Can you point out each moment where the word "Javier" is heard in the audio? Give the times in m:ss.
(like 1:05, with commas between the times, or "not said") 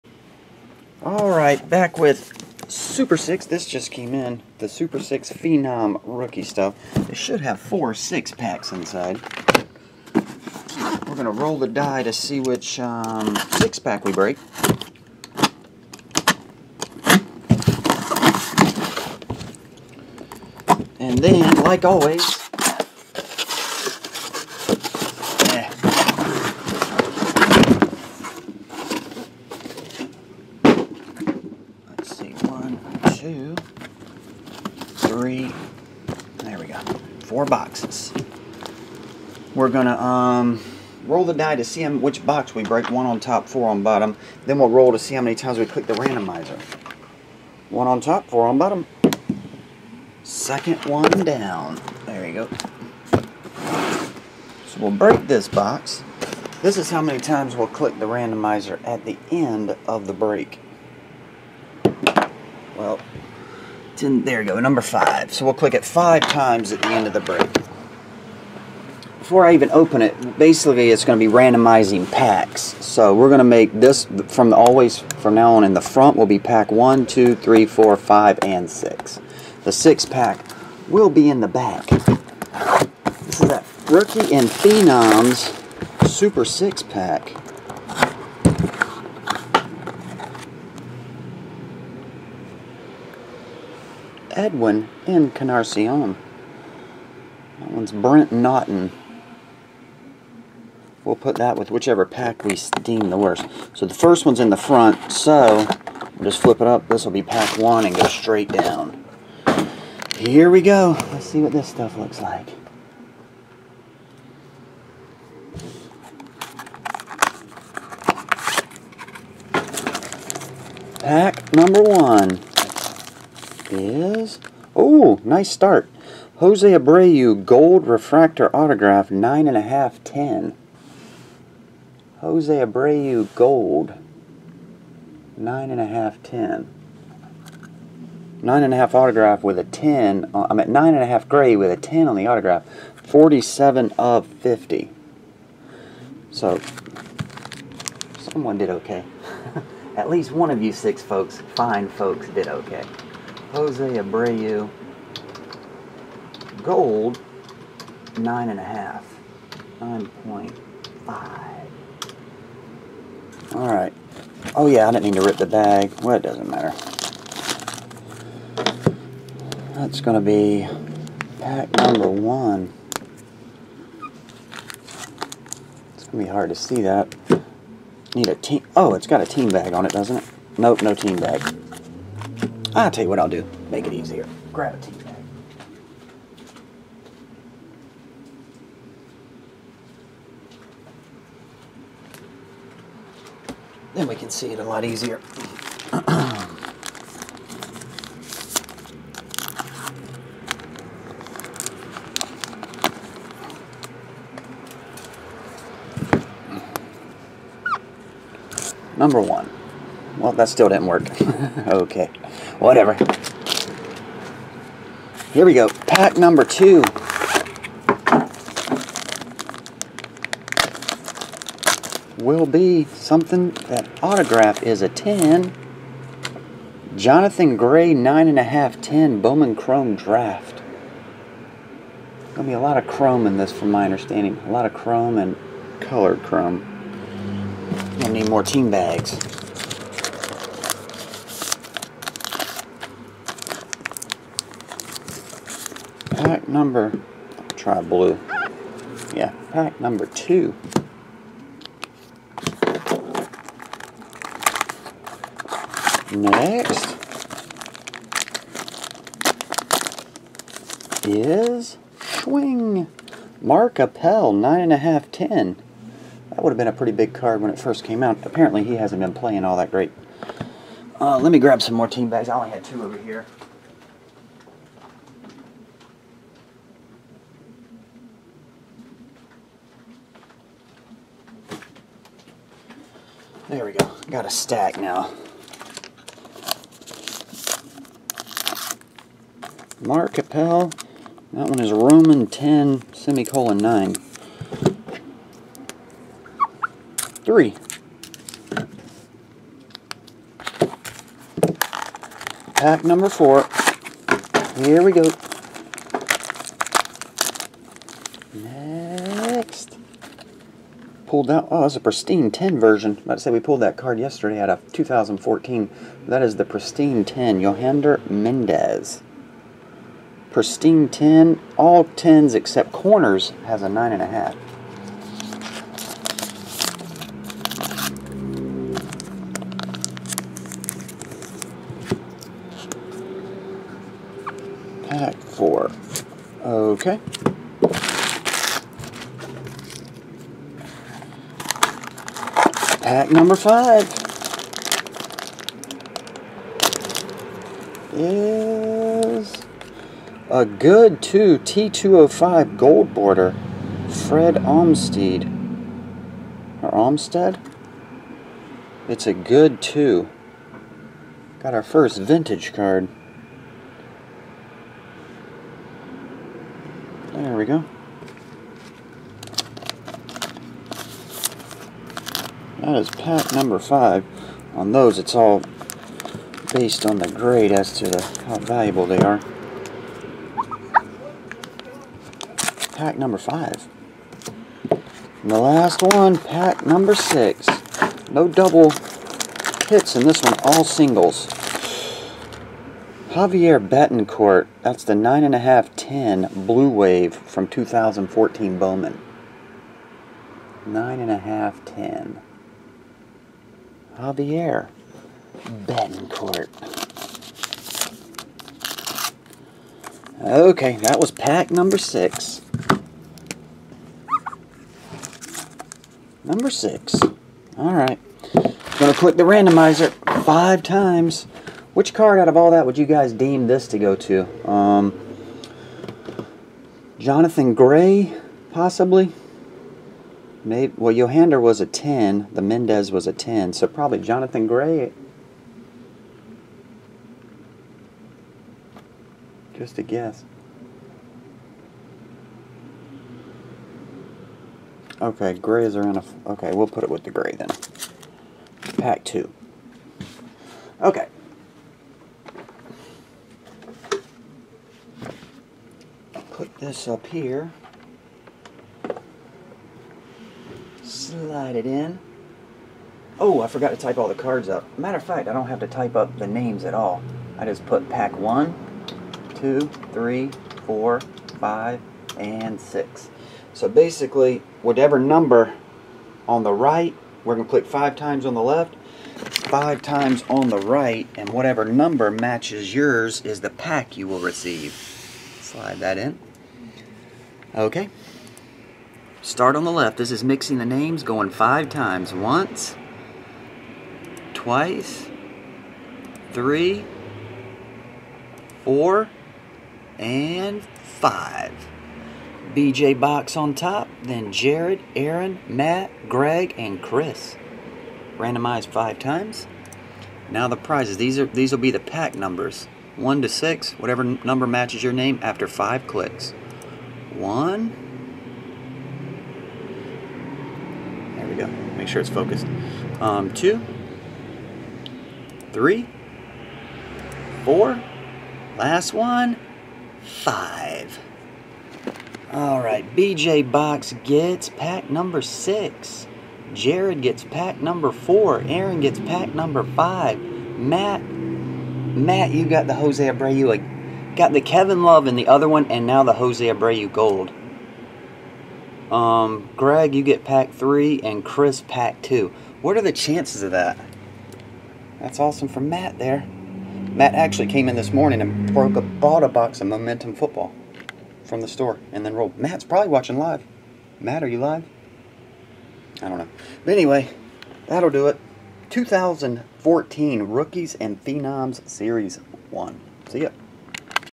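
6:33, 6:43.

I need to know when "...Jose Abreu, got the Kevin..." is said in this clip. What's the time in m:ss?
9:02.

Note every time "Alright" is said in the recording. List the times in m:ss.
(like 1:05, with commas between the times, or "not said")
0:01, 2:43, 6:57.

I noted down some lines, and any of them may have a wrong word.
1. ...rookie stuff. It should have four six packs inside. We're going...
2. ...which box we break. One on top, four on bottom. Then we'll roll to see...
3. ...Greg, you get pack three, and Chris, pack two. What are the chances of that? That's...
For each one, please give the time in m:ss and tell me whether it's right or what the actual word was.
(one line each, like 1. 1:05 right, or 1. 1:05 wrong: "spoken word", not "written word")
1. 0:06 right
2. 0:41 right
3. 9:09 right.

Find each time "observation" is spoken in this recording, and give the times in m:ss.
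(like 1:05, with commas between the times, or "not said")
not said.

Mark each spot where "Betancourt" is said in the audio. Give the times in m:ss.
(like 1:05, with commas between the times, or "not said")
6:33, 6:45.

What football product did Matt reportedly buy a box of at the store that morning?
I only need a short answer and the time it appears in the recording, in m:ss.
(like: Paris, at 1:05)
Momentum Football, at 9:19.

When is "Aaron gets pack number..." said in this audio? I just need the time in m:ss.
8:58.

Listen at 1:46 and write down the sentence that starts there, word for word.
This will be pack one and go straight down.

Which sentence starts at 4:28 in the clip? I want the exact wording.
Apparently he hasn't been playing all that great.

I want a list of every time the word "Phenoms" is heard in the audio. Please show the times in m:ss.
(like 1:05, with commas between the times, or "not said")
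0:05, 1:24, 9:31.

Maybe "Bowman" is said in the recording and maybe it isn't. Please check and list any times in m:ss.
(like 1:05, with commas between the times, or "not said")
3:49, 6:38.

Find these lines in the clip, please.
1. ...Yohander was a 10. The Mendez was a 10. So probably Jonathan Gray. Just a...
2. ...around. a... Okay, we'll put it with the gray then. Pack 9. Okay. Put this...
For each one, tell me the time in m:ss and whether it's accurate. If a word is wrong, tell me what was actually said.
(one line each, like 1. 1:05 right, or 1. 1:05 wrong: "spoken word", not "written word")
1. 7:10 right
2. 7:25 wrong: "2", not "9".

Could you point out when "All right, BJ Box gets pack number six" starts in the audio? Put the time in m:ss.
8:52.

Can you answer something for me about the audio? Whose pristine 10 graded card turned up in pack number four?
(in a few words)
Yohander Mendez.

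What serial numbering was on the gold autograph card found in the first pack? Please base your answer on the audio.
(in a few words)
47 of 50.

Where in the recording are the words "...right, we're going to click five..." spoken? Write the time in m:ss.
7:56.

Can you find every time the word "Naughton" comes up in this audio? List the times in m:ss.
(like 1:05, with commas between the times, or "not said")
1:38.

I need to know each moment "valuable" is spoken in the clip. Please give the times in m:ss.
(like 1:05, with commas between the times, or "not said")
6:18.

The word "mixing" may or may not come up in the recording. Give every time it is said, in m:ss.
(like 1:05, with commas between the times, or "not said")
8:10.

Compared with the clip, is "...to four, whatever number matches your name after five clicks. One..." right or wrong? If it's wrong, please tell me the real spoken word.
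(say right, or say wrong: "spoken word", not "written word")
wrong: "six", not "four".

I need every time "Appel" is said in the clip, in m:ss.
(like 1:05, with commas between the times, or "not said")
4:23, 4:50.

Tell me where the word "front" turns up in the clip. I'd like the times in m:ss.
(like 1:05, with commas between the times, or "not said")
1:15, 1:44.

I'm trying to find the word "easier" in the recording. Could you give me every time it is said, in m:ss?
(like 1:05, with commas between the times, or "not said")
3:03, 3:14.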